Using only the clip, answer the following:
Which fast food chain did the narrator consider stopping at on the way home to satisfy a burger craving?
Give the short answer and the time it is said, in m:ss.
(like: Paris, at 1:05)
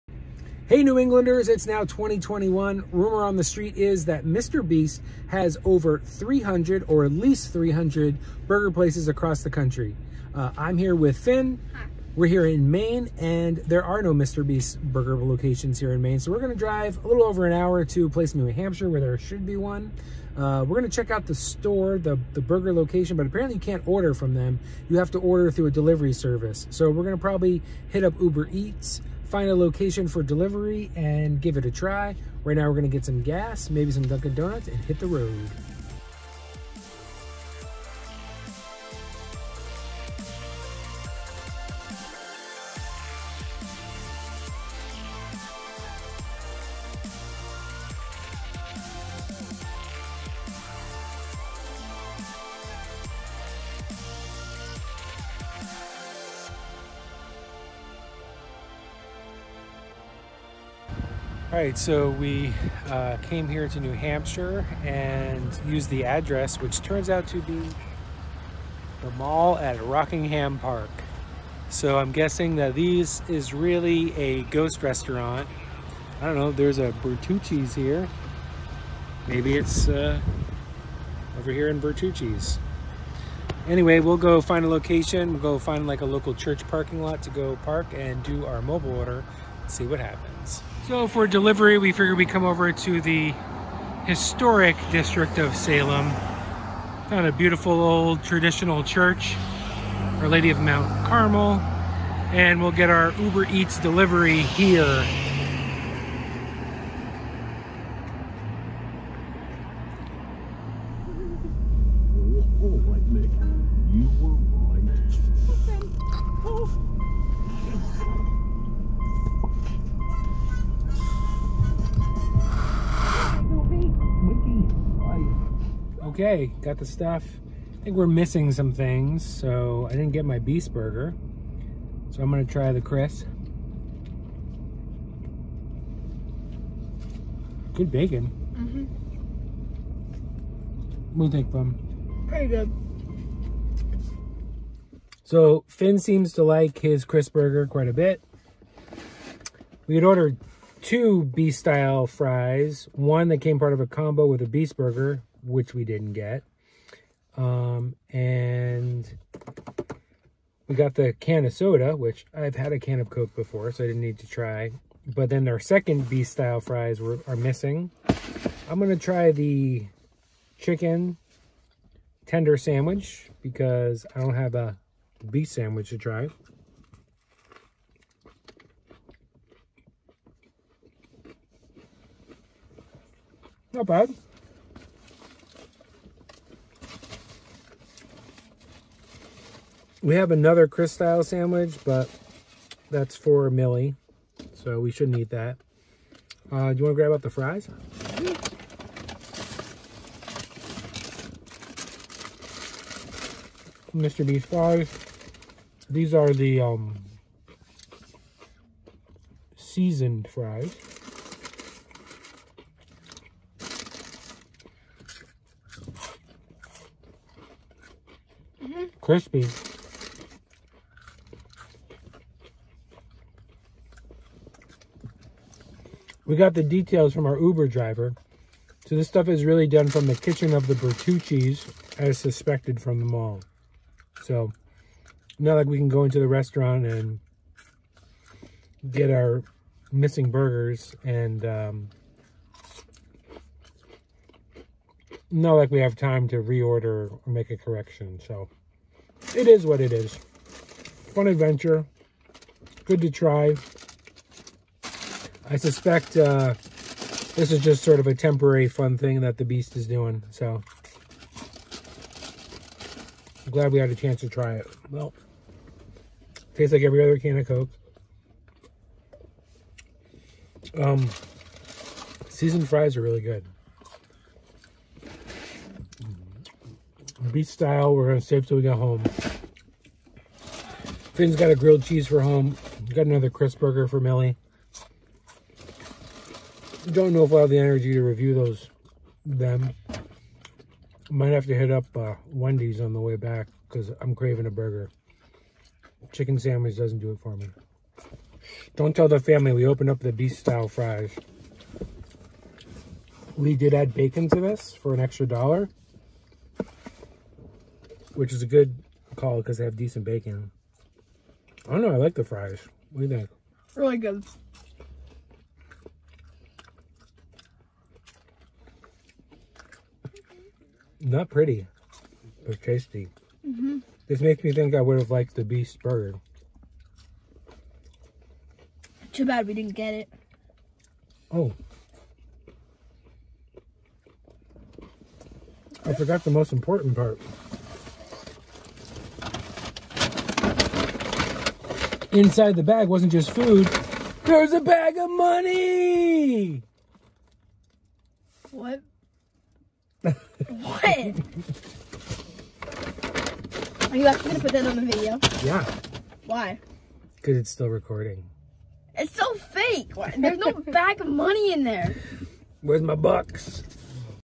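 Wendy's, at 4:52.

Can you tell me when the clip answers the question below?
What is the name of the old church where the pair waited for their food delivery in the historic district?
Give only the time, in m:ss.
1:40.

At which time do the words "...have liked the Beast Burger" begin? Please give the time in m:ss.
5:24.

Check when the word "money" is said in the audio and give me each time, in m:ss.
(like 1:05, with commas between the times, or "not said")
5:45, 6:01.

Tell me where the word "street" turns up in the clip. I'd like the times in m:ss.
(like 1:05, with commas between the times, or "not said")
0:03.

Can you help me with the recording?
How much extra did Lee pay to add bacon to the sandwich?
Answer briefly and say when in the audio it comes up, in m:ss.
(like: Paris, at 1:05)
1 dollar, at 5:04.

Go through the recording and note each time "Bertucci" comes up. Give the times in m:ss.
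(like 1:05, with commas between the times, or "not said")
1:17, 1:21, 3:50.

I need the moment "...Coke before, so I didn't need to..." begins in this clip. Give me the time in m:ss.
2:43.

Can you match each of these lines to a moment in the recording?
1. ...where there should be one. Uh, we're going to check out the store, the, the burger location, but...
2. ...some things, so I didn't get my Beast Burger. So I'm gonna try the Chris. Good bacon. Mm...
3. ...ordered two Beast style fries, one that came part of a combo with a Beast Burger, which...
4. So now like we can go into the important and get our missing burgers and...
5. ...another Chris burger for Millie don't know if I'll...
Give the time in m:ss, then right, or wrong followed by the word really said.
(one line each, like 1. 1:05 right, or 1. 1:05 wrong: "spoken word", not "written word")
1. 0:18 right
2. 2:08 right
3. 2:30 right
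4. 3:54 wrong: "restaurant", not "important"
5. 4:43 right.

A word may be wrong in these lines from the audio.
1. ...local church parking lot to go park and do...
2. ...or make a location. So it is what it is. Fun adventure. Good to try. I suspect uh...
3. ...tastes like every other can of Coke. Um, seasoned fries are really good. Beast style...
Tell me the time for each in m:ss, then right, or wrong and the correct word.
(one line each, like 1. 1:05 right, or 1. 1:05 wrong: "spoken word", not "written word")
1. 1:26 right
2. 4:07 wrong: "correction", not "location"
3. 4:26 right.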